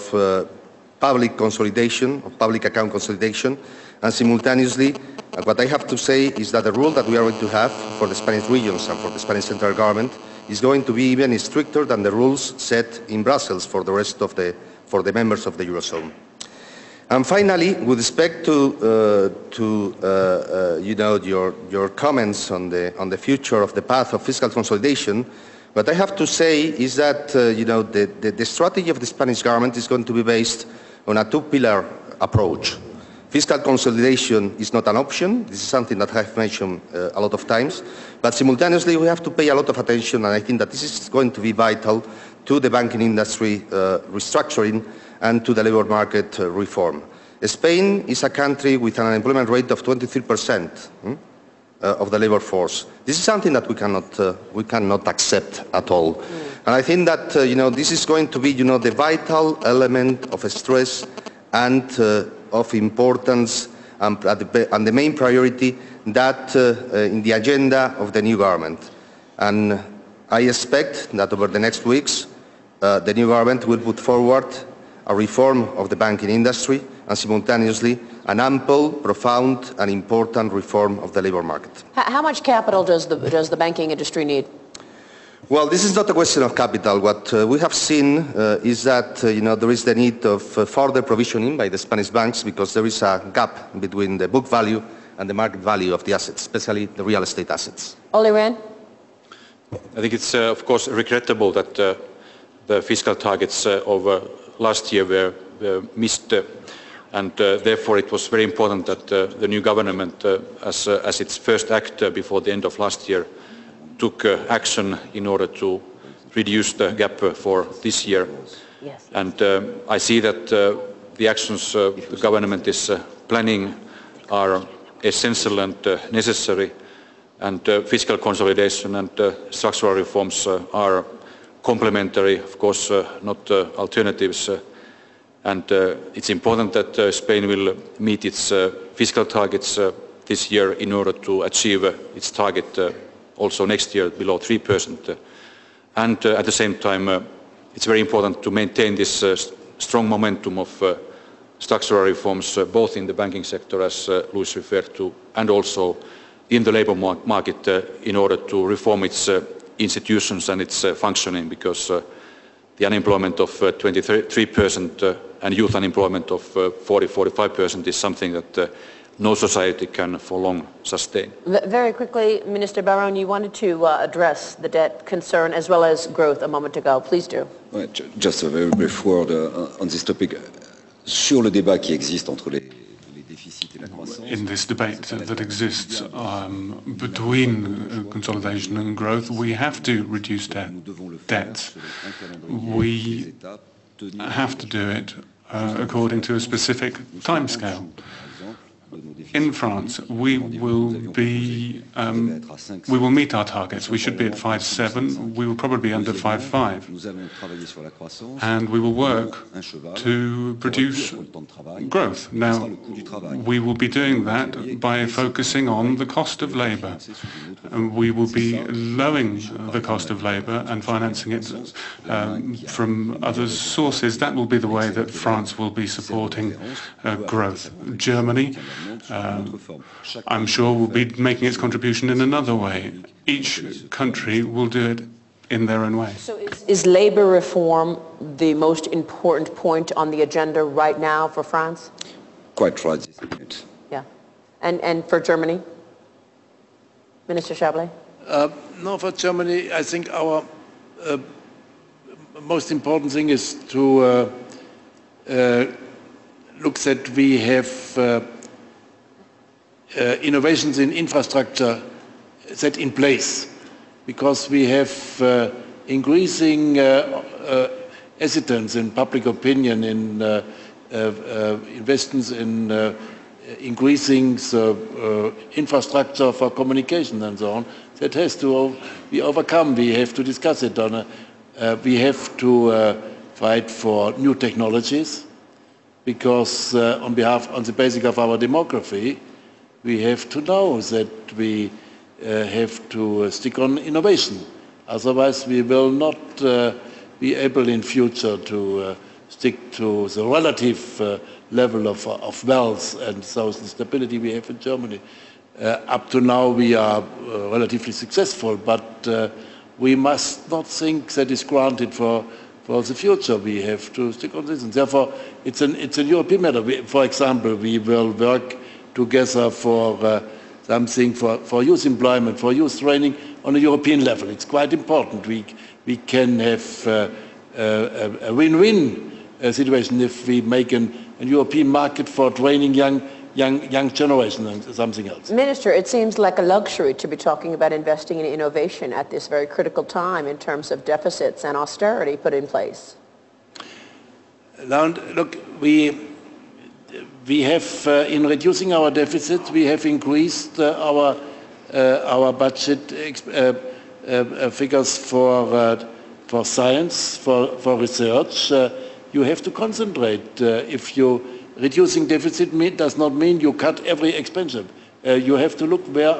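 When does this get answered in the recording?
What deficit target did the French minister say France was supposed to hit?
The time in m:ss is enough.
3:24.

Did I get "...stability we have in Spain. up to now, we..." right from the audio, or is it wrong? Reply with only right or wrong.
wrong.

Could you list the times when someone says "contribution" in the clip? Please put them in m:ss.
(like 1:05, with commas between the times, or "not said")
3:51.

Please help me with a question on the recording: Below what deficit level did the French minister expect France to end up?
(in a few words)
5.5.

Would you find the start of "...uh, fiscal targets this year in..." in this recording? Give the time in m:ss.
2:18.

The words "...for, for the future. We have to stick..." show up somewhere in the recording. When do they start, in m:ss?
5:11.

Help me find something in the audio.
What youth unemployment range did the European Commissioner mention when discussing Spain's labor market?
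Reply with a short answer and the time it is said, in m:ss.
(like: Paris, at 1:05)
40-45%, at 2:46.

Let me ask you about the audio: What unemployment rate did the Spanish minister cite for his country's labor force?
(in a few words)
23 percent.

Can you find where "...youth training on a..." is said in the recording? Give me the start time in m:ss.
5:22.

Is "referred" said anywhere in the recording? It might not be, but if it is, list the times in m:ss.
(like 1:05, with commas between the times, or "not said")
2:34.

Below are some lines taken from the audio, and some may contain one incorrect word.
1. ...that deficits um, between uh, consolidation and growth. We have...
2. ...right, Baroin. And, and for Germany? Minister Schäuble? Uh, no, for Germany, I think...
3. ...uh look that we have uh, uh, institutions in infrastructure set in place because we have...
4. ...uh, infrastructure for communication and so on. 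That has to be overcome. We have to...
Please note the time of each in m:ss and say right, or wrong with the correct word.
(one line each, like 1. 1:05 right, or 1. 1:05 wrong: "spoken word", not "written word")
1. 3:05 wrong: "exists", not "deficits"
2. 4:02 wrong: "Yeah", not "Baroin"
3. 4:15 wrong: "innovations", not "institutions"
4. 4:34 right.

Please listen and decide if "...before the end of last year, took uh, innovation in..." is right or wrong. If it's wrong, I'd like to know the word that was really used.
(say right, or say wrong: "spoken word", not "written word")
wrong: "action", not "innovation".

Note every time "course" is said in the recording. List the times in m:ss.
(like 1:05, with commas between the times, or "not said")
1:40, 2:12.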